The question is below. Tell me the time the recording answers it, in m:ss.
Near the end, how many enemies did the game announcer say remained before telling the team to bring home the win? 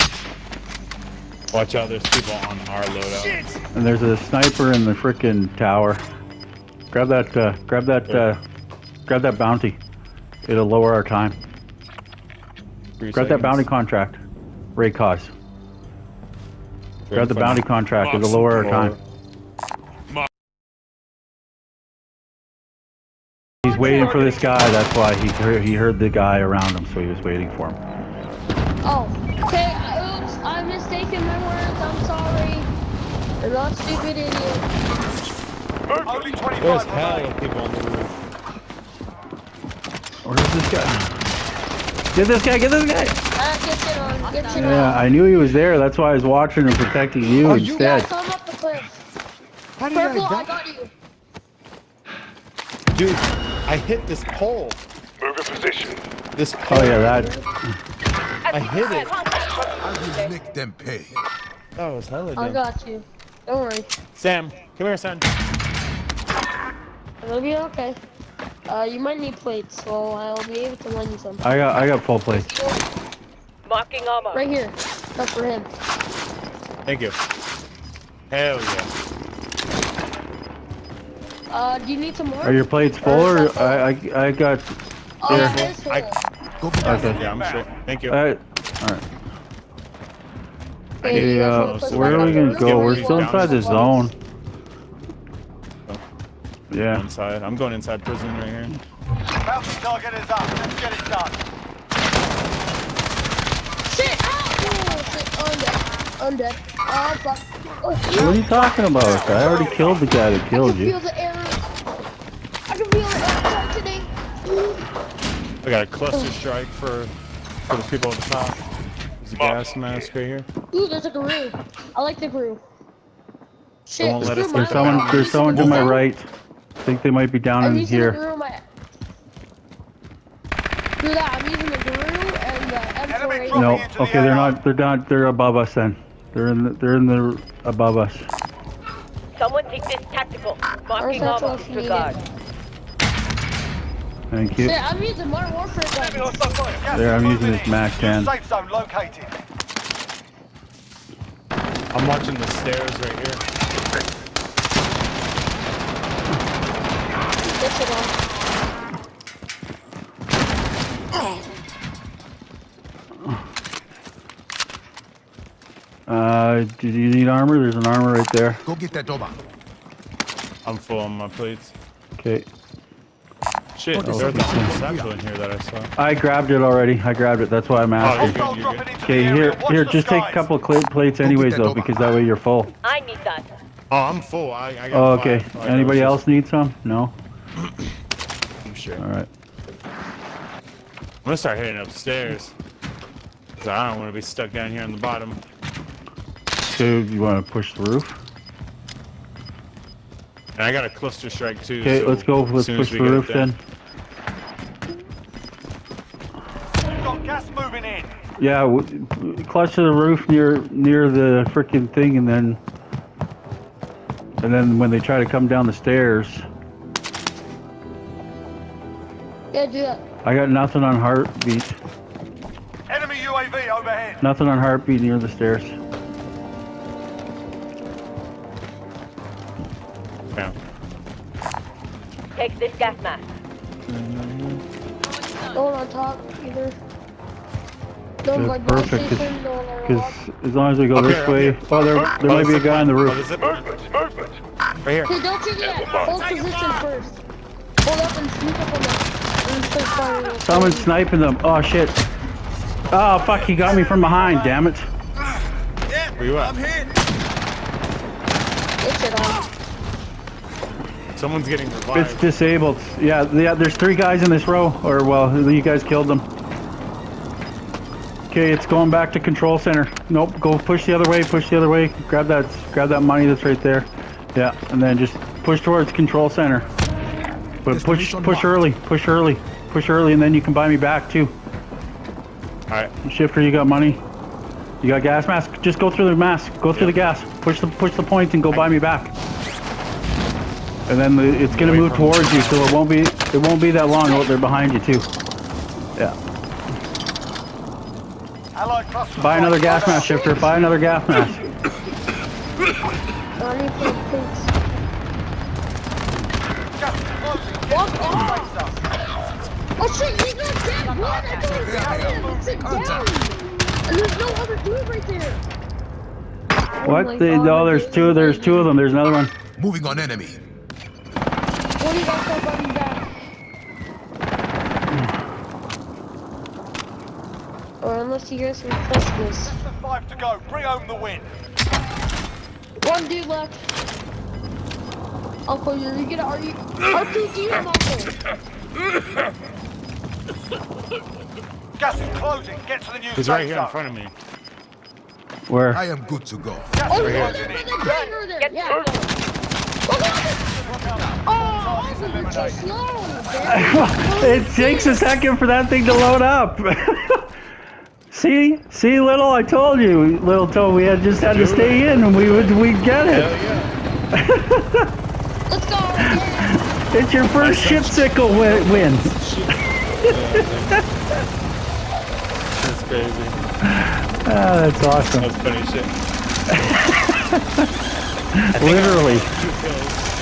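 5:29.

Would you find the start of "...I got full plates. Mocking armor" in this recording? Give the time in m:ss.
1:11.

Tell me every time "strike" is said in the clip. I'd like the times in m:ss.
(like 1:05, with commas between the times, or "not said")
1:56, 3:21.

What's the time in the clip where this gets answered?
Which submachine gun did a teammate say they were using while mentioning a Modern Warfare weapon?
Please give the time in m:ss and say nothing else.
2:27.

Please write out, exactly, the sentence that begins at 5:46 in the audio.
Gas oh, right there, there, there, there.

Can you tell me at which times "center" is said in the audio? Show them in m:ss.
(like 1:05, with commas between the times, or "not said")
4:29, 4:36.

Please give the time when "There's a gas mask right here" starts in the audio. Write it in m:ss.
1:59.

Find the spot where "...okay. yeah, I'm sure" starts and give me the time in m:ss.
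1:26.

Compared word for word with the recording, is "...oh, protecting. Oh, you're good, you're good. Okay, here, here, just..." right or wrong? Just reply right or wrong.
wrong.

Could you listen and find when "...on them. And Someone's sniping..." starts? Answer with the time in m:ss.
4:08.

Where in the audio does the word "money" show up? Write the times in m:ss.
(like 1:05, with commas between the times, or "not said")
4:32, 4:43.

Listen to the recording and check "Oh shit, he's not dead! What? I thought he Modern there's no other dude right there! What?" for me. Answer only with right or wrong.
wrong.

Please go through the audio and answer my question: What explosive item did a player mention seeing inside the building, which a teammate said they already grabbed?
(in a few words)
A satchel.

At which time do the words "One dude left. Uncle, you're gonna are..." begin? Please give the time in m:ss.
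5:32.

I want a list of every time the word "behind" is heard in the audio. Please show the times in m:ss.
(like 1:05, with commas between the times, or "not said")
4:14, 4:54.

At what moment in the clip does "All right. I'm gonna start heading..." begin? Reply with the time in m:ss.
3:08.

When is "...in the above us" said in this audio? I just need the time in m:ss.
2:16.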